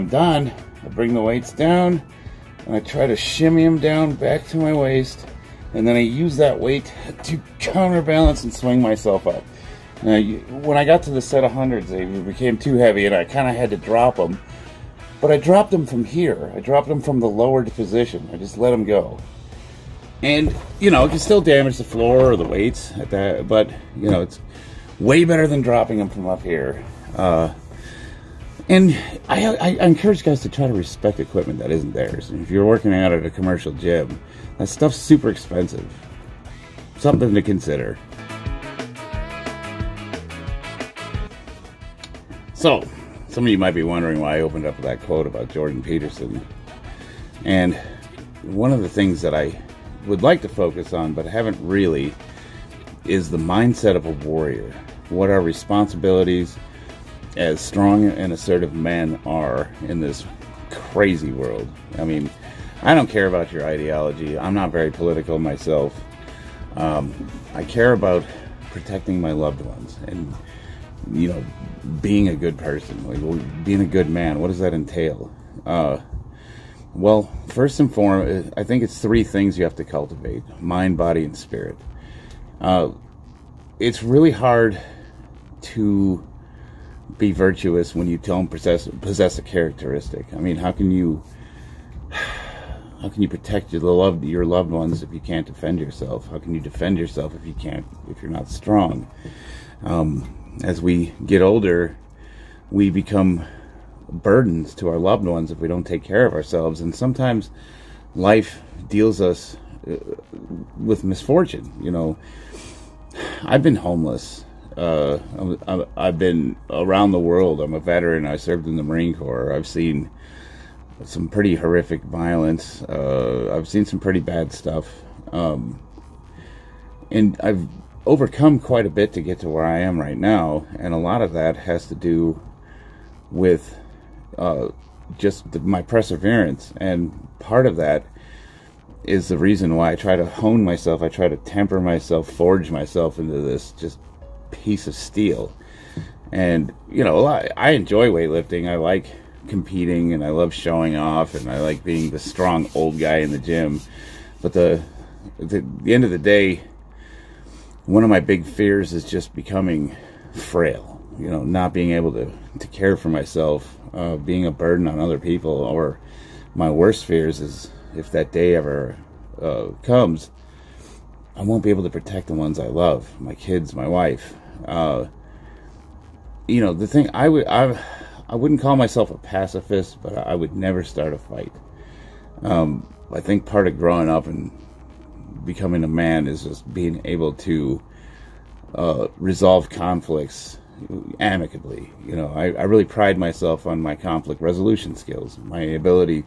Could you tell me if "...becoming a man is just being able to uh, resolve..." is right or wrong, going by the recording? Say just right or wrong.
right.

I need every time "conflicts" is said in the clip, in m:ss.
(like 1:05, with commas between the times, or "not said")
3:09, 3:13.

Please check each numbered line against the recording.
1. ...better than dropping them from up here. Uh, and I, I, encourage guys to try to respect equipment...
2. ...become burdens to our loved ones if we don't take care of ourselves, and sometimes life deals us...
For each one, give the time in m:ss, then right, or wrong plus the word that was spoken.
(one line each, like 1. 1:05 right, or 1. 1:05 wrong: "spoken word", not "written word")
1. 0:25 right
2. 1:42 right.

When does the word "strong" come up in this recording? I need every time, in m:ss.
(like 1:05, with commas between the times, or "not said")
0:57, 1:38, 2:32.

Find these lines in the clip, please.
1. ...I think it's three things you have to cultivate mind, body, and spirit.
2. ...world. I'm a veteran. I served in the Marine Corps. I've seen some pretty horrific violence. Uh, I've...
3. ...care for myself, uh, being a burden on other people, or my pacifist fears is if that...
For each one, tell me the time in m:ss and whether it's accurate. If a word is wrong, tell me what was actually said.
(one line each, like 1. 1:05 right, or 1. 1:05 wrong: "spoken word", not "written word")
1. 1:18 right
2. 1:57 right
3. 2:42 wrong: "worst", not "pacifist".